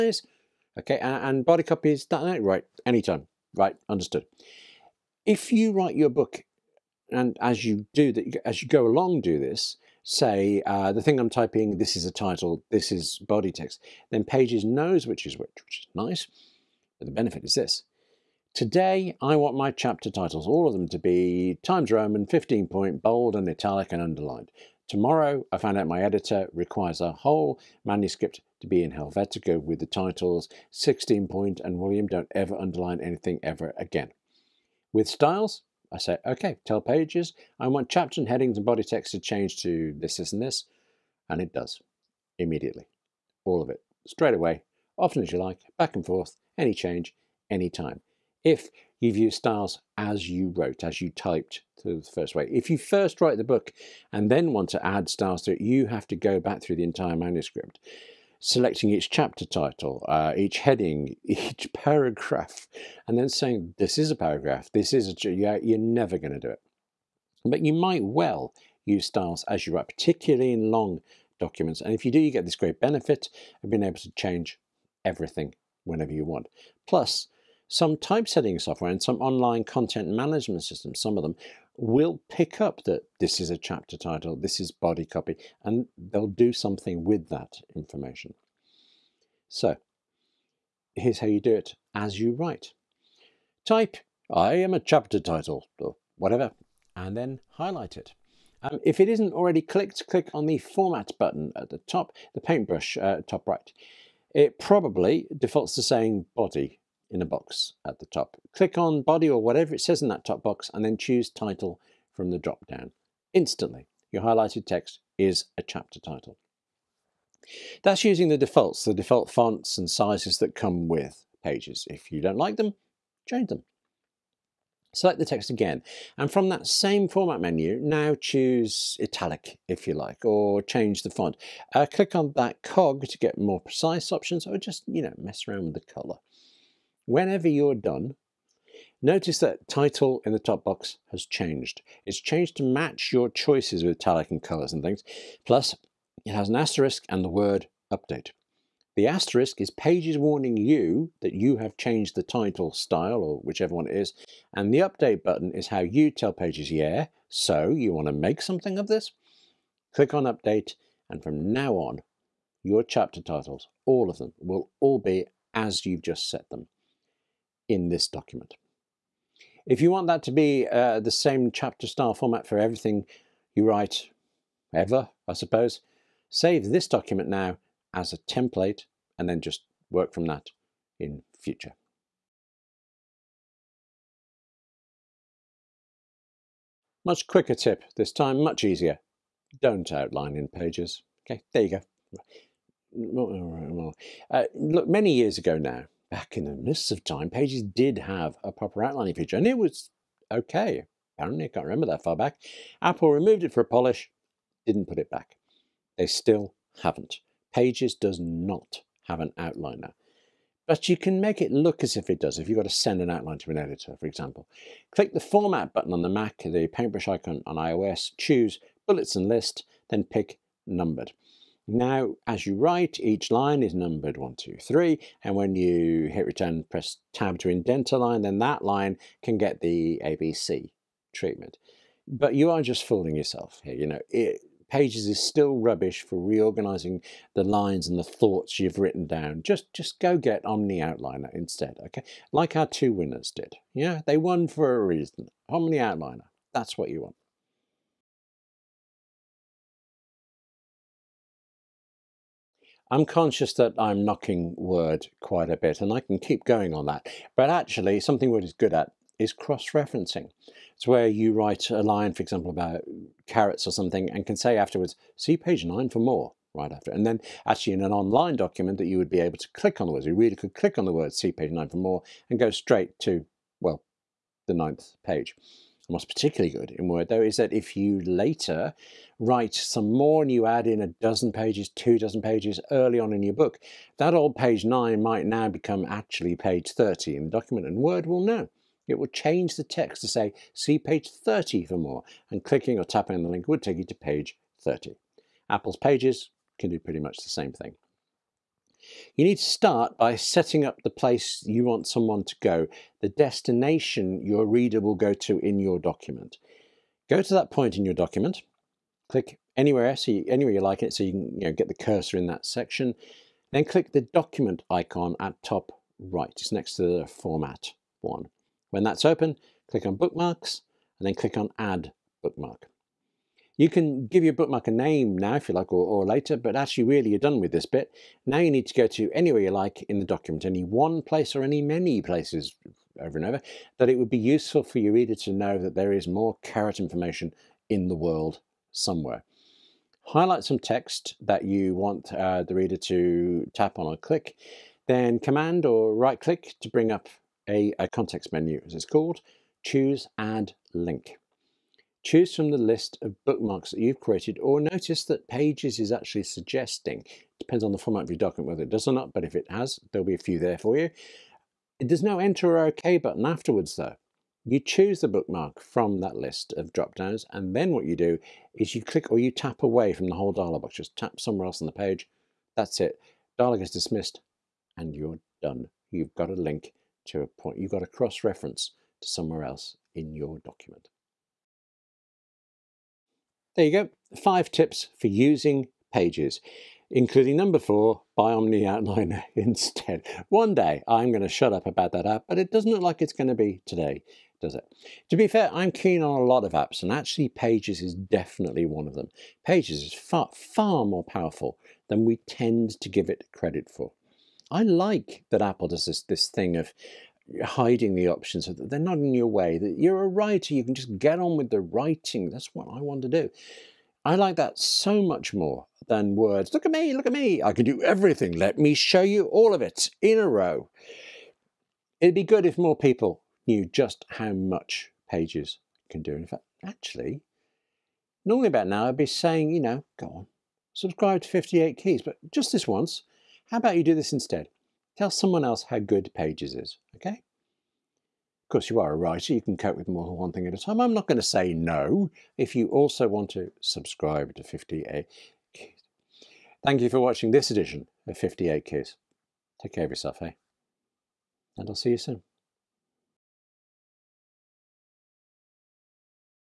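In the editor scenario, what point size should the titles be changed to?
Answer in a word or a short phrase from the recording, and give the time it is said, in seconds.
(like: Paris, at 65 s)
16, at 30 s.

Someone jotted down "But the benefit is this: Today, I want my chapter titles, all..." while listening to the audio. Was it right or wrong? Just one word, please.
right.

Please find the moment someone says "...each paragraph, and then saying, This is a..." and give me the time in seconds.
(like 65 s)
61 s.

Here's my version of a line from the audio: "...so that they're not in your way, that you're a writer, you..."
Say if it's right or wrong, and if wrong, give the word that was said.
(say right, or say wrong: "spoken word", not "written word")
right.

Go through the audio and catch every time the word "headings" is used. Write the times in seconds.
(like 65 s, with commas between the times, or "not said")
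38 s, 60 s.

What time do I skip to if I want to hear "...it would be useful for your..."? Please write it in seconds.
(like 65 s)
333 s.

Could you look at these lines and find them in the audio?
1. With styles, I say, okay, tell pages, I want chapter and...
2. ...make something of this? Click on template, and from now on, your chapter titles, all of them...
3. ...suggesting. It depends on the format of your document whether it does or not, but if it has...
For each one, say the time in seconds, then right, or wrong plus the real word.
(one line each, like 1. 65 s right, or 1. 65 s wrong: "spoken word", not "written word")
1. 34 s right
2. 158 s wrong: "update", not "template"
3. 356 s right.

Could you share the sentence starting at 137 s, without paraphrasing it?
Whenever you're done, notice that title in the top box has changed.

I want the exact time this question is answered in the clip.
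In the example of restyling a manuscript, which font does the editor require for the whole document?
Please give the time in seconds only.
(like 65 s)
28 s.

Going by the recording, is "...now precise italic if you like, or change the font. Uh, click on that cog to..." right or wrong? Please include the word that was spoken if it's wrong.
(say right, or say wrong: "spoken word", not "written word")
wrong: "choose", not "precise".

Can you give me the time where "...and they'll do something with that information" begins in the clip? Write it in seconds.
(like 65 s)
85 s.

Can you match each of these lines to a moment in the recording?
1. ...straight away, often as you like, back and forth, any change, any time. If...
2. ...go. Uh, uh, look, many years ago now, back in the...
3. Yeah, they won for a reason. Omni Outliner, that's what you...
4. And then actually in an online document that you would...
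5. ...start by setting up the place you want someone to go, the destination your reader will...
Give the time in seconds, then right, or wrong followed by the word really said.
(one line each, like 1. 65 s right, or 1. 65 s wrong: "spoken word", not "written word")
1. 44 s right
2. 191 s right
3. 243 s right
4. 266 s right
5. 299 s right.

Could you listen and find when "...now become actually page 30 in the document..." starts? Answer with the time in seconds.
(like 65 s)
285 s.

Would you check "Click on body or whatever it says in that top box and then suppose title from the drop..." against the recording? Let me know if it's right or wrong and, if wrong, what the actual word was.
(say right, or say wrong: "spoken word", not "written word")
wrong: "choose", not "suppose".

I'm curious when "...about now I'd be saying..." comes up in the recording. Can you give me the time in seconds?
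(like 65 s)
428 s.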